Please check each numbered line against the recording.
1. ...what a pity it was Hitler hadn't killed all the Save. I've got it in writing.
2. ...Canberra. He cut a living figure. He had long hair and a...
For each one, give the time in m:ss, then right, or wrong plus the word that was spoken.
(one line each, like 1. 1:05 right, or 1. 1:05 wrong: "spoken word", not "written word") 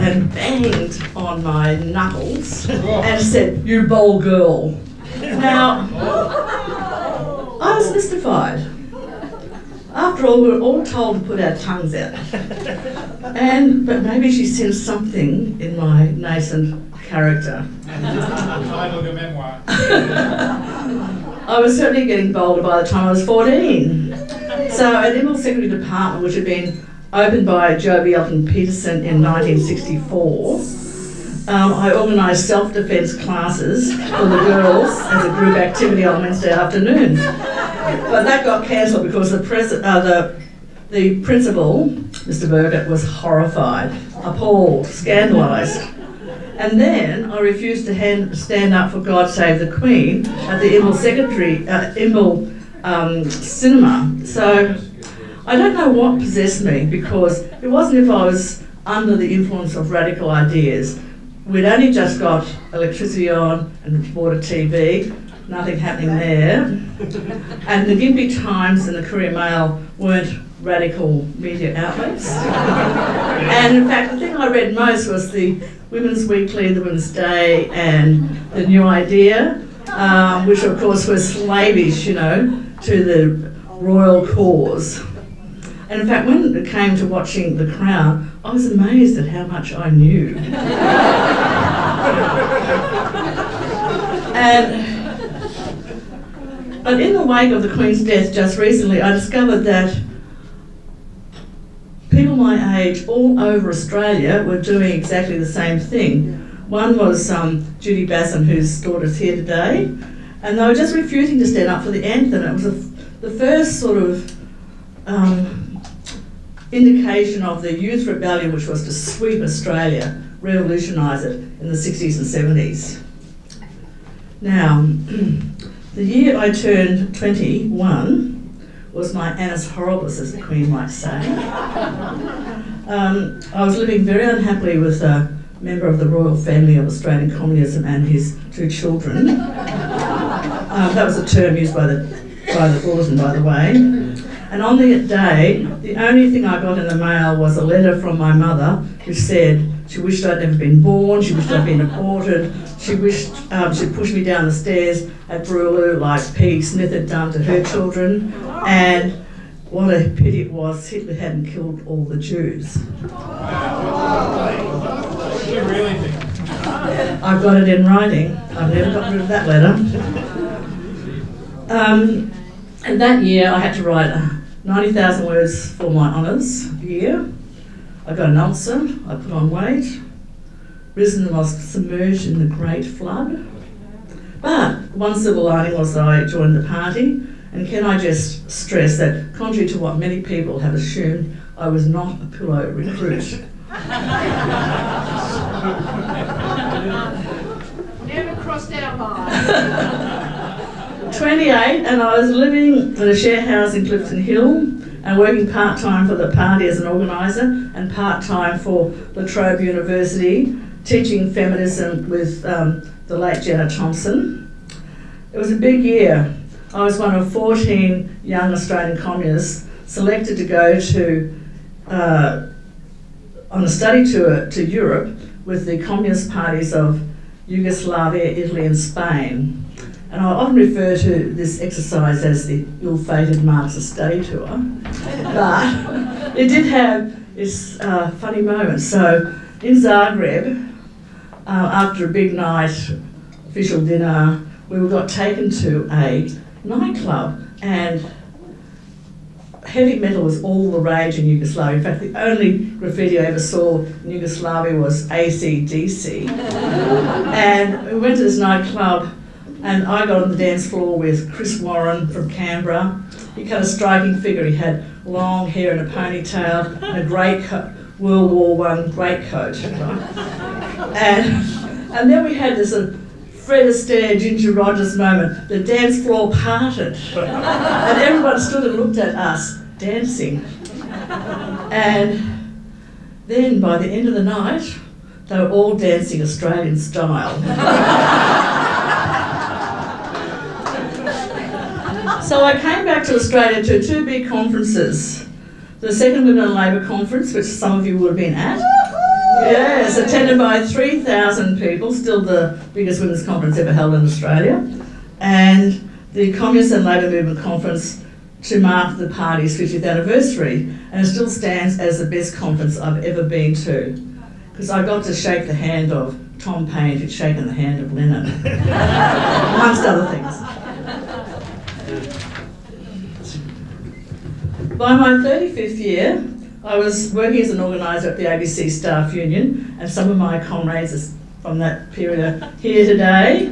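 1. 2:39 wrong: "Jews", not "Save"
2. 4:22 wrong: "striking", not "living".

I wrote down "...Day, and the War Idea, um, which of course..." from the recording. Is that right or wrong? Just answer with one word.
wrong.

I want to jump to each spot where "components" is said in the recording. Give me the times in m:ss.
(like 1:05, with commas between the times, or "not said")
not said.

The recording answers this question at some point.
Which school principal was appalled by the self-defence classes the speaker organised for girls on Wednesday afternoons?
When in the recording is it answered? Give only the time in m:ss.
0:41.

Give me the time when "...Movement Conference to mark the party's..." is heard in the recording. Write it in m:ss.
5:07.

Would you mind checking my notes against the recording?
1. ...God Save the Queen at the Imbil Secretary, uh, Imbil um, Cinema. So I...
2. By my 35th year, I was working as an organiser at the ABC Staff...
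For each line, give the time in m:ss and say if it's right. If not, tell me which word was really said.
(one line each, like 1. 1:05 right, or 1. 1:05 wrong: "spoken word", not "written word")
1. 0:49 right
2. 5:24 right.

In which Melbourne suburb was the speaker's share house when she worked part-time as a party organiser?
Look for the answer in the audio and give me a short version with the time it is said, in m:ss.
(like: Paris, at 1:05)
Clifton Hill, at 3:23.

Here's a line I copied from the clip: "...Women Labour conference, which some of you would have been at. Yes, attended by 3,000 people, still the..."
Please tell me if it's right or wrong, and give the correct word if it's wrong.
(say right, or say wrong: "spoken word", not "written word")
right.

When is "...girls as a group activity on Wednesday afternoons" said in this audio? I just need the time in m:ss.
0:34.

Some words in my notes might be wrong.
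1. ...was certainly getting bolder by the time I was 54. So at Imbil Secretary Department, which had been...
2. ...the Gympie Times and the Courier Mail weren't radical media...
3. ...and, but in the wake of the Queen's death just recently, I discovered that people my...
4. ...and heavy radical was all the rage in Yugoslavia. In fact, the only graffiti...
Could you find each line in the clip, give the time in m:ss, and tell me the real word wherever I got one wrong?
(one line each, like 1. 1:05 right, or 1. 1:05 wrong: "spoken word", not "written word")
1. 0:21 wrong: "14", not "54"
2. 1:07 right
3. 1:34 right
4. 4:07 wrong: "metal", not "radical".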